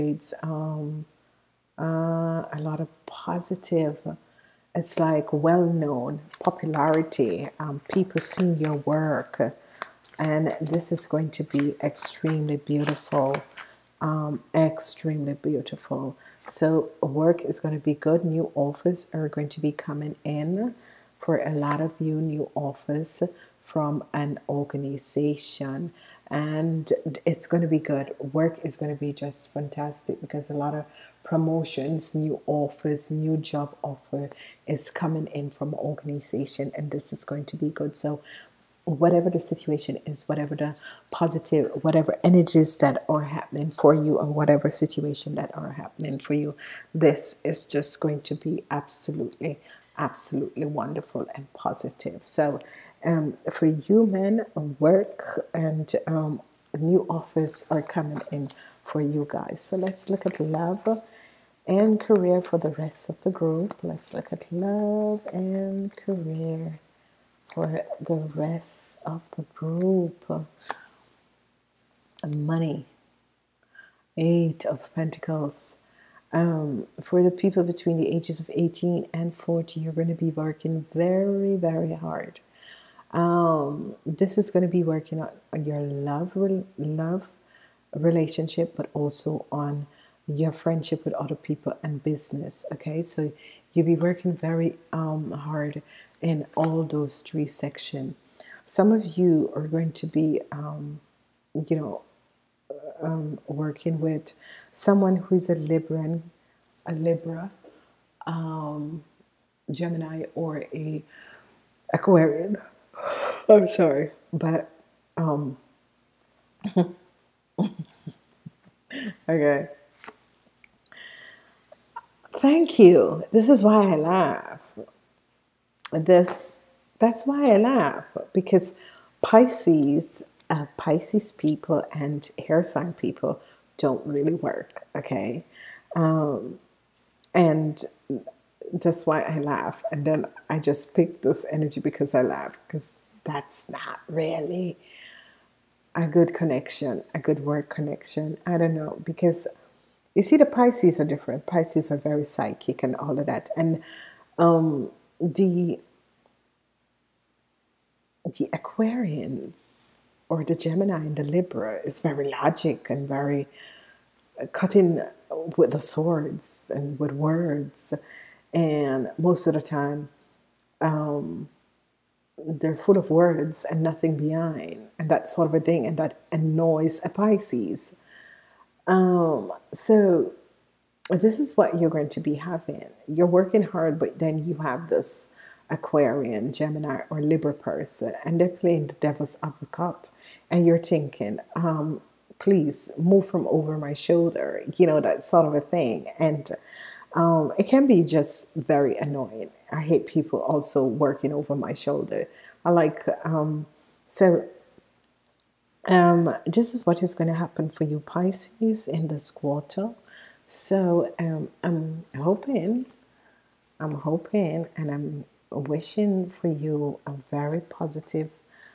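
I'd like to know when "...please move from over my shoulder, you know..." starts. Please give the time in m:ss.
3:12.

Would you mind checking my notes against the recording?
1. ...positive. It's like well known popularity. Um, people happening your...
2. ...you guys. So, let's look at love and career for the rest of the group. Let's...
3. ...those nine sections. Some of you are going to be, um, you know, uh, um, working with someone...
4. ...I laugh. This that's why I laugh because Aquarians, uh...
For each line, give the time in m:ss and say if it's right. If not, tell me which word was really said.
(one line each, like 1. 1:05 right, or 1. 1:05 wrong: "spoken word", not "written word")
1. 0:03 wrong: "seeing", not "happening"
2. 0:58 right
3. 1:36 wrong: "three", not "nine"
4. 2:03 wrong: "Pisces", not "Aquarians".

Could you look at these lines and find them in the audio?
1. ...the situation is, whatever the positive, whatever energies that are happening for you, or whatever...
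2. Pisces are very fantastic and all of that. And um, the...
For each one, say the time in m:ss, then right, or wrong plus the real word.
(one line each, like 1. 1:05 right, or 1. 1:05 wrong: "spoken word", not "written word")
1. 0:39 right
2. 2:31 wrong: "psychic", not "fantastic".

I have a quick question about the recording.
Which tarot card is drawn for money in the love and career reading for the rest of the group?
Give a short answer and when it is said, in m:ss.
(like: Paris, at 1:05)
Eight of Pentacles, at 1:14.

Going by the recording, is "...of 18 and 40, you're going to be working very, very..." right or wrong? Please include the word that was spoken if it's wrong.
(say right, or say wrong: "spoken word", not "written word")
right.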